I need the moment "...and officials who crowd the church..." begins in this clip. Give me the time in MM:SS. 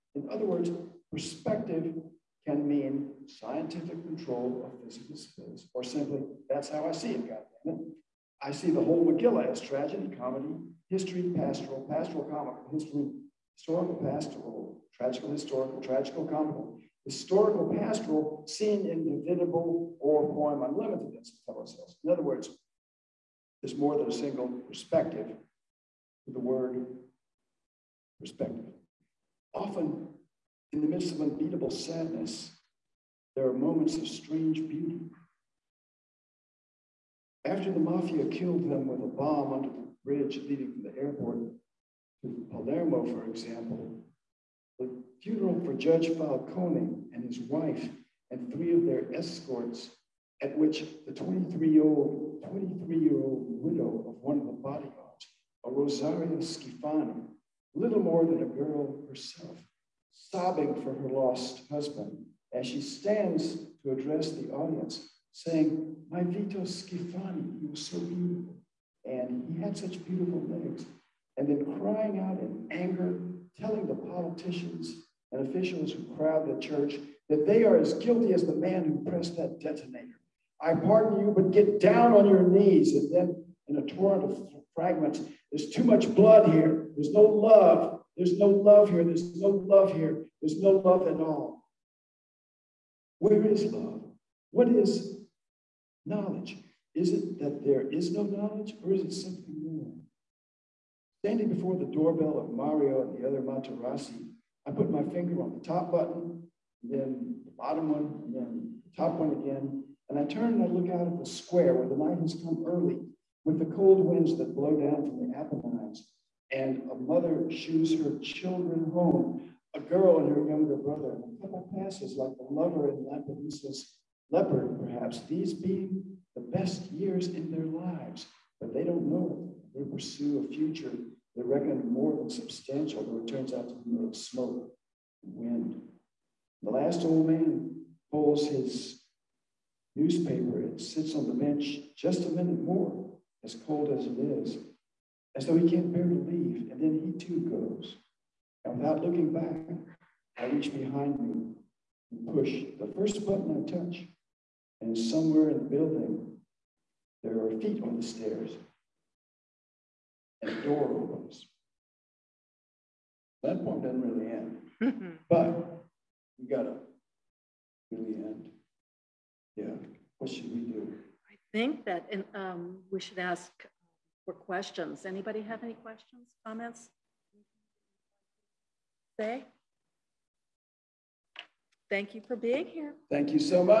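01:15.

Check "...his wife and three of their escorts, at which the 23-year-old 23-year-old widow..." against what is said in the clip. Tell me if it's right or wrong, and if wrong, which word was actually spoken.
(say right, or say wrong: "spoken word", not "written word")
right.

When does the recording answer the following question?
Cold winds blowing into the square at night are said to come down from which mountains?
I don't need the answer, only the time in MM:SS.
01:55.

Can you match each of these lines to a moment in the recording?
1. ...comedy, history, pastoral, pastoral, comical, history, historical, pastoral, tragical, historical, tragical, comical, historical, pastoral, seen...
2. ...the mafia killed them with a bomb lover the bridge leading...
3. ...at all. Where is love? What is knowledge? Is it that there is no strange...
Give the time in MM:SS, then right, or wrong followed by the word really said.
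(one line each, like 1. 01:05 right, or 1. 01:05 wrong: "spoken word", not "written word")
1. 00:10 right
2. 00:37 wrong: "under", not "lover"
3. 01:31 wrong: "knowledge", not "strange".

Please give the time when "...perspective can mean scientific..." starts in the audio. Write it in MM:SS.
00:01.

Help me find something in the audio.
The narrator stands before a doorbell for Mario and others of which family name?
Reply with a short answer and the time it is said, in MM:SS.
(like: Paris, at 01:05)
Materassi, at 01:43.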